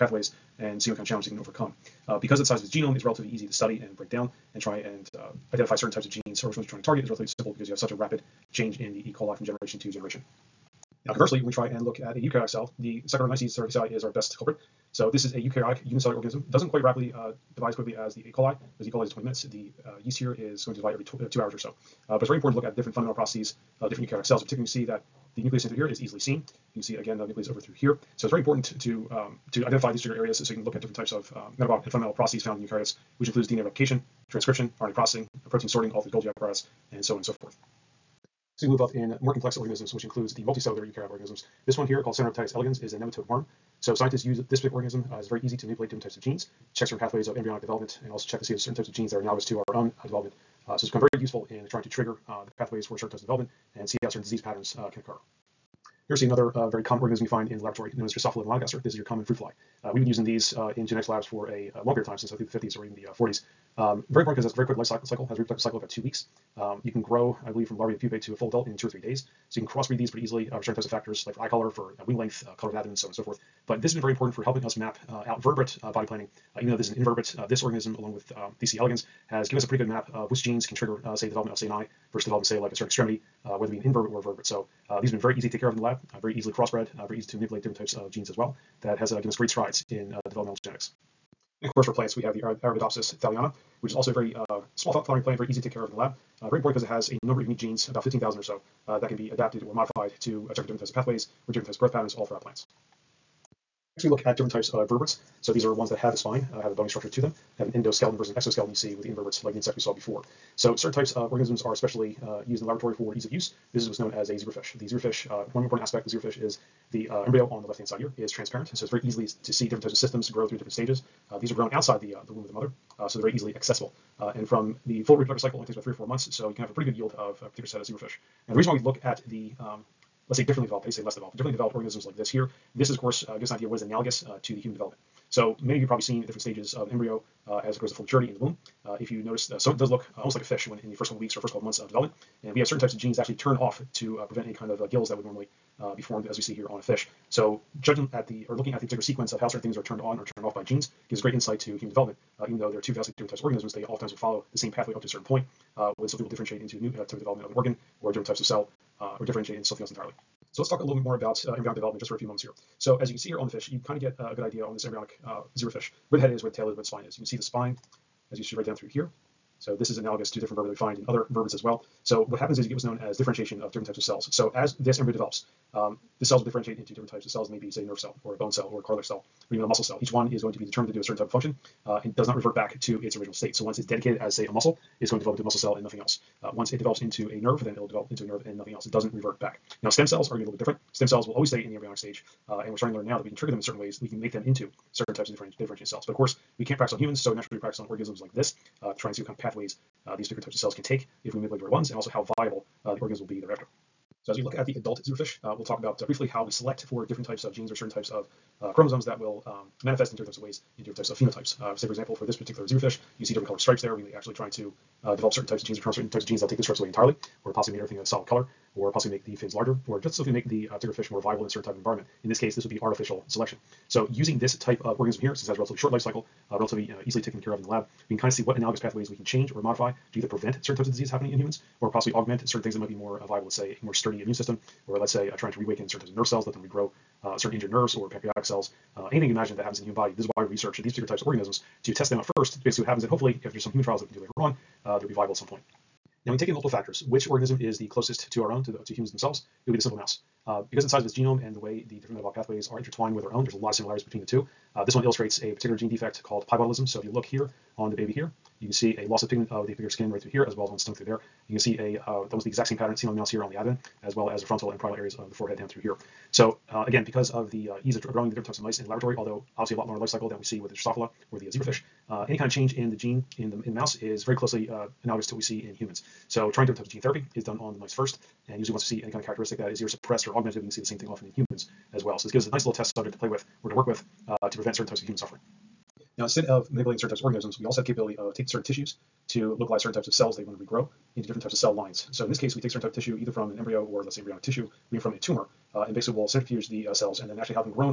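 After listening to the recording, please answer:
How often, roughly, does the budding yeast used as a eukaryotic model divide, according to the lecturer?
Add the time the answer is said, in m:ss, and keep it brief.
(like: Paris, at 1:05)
every 2 hours, at 0:20.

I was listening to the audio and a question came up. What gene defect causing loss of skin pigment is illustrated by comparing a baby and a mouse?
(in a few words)
piebaldism.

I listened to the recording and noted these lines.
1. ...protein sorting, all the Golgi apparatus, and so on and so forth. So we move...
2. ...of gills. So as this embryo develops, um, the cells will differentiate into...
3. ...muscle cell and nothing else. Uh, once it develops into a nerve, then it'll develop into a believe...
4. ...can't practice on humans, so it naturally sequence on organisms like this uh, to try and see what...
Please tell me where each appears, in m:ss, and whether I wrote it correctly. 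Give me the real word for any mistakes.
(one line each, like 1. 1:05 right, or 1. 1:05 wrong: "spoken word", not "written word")
1. 0:35 right
2. 2:53 wrong: "cells", not "gills"
3. 3:05 wrong: "nerve", not "believe"
4. 3:16 wrong: "practice", not "sequence".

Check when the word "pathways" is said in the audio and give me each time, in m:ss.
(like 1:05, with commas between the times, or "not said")
0:46, 0:52, 1:40, 2:34, 3:19, 3:48, 4:12.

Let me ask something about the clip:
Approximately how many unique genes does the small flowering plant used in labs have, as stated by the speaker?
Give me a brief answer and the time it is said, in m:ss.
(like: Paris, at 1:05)
15,000, at 1:37.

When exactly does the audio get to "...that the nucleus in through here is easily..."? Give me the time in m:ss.
0:24.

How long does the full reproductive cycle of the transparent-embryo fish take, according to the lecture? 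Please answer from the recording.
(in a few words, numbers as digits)
3 or 4 months.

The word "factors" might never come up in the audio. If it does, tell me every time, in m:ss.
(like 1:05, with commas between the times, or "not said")
1:10, 4:06.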